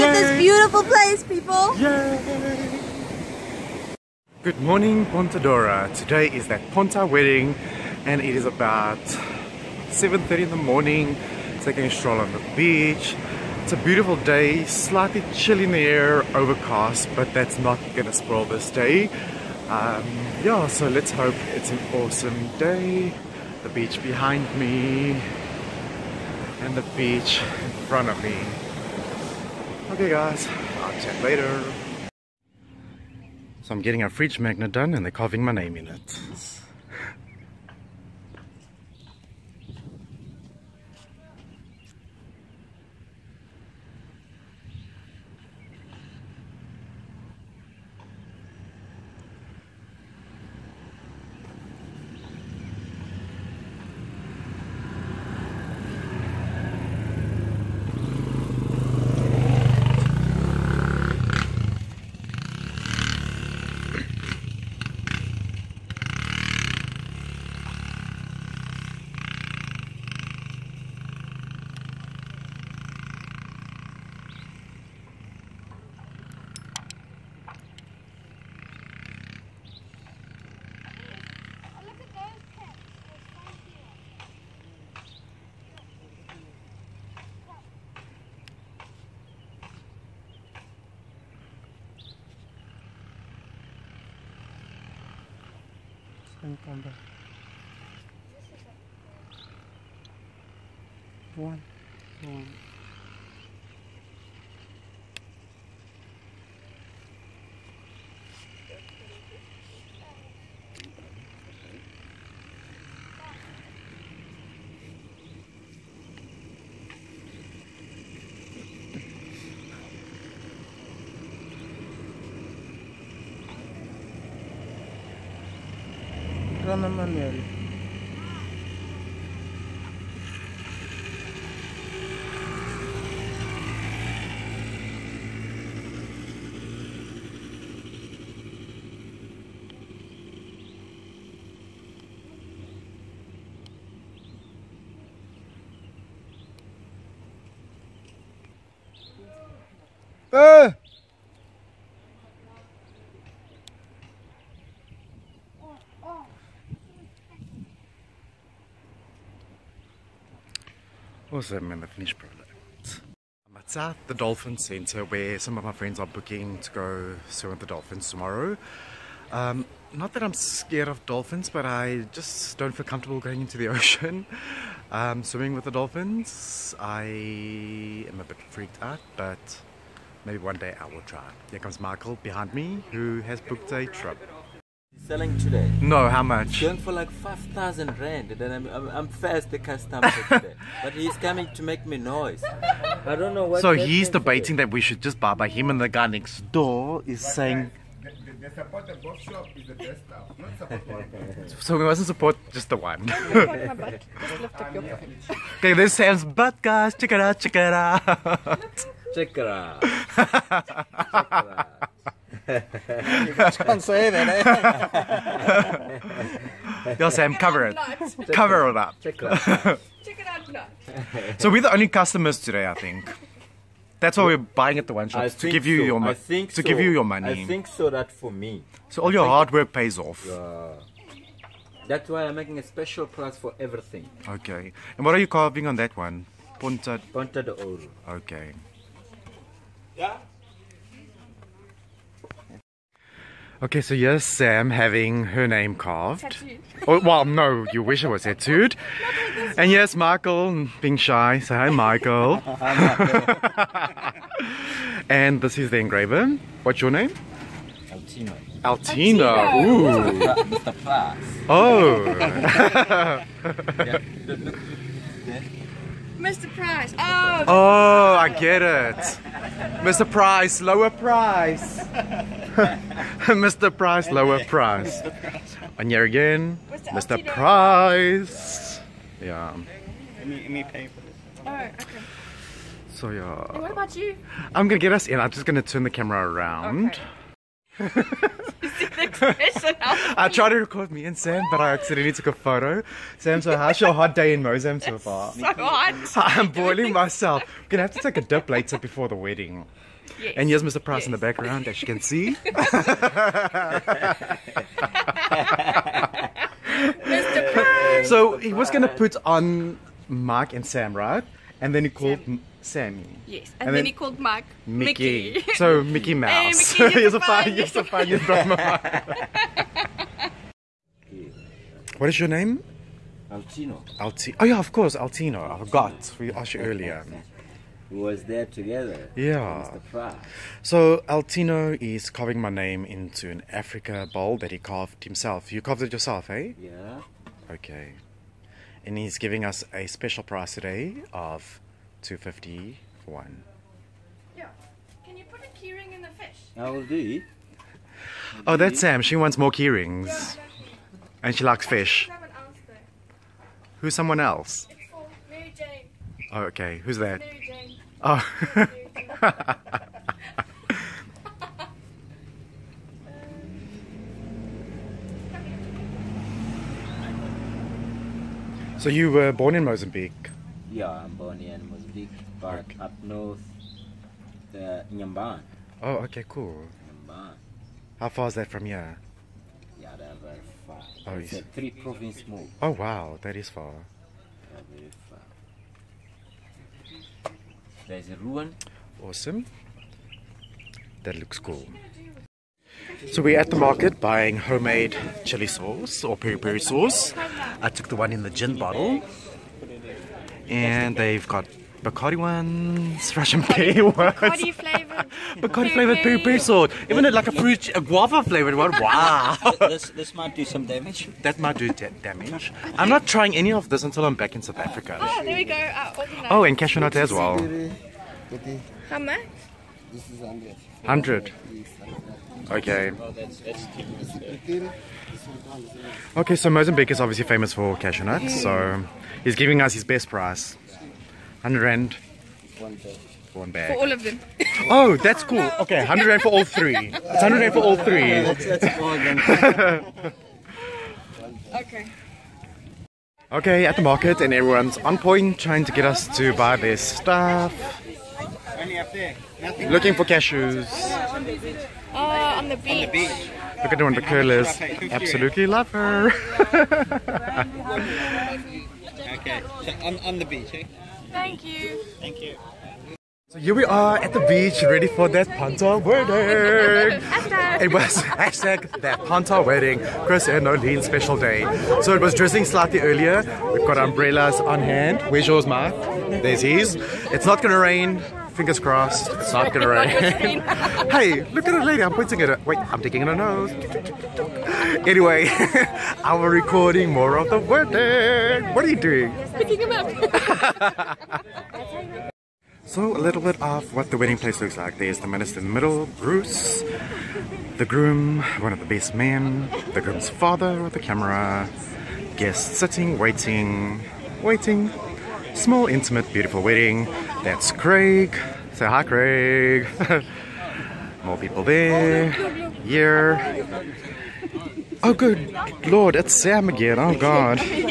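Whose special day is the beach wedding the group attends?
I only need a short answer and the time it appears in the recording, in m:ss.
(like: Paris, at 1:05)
Chris and Nolene, at 7:50.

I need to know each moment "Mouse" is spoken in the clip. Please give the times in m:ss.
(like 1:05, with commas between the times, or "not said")
5:16.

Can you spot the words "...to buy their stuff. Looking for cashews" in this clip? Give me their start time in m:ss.
7:26.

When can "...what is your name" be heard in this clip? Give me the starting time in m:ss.
5:21.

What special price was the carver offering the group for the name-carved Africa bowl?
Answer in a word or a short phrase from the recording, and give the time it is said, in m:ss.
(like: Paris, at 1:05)
251, at 5:42.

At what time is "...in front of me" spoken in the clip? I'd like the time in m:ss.
0:27.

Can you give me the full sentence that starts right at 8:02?
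Wait, I'm digging in her nose.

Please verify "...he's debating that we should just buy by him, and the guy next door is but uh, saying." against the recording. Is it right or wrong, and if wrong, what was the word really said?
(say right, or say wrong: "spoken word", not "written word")
right.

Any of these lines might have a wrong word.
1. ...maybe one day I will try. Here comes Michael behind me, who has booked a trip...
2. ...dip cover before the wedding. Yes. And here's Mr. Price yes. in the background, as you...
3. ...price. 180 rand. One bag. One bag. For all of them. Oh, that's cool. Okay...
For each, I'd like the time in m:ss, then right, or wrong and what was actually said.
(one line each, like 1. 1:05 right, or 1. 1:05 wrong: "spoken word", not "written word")
1. 3:00 right
2. 4:58 wrong: "later", not "cover"
3. 7:10 wrong: "100", not "180".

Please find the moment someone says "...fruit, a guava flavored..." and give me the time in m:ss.
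6:47.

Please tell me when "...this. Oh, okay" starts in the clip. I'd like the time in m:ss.
4:41.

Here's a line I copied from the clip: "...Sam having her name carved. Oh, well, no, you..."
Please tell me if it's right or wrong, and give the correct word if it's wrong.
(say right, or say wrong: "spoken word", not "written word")
right.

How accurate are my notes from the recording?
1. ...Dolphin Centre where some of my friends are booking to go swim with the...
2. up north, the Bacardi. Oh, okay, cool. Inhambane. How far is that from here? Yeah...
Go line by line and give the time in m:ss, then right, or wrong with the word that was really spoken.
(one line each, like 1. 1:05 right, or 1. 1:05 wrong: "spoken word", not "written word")
1. 2:44 right
2. 6:12 wrong: "Inhambane", not "Bacardi".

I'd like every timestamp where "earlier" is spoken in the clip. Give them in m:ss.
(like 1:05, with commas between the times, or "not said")
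5:26, 7:52.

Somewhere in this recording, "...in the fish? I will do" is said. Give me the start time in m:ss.
5:45.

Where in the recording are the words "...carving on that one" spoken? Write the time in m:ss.
3:55.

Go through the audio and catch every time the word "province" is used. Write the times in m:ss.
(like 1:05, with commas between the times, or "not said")
6:21.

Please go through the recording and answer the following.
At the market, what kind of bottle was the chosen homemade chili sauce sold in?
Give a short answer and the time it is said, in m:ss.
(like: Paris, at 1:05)
gin bottle, at 6:38.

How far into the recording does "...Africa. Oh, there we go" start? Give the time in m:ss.
6:54.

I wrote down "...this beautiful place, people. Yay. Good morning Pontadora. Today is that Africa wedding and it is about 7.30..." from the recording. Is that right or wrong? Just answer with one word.
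wrong.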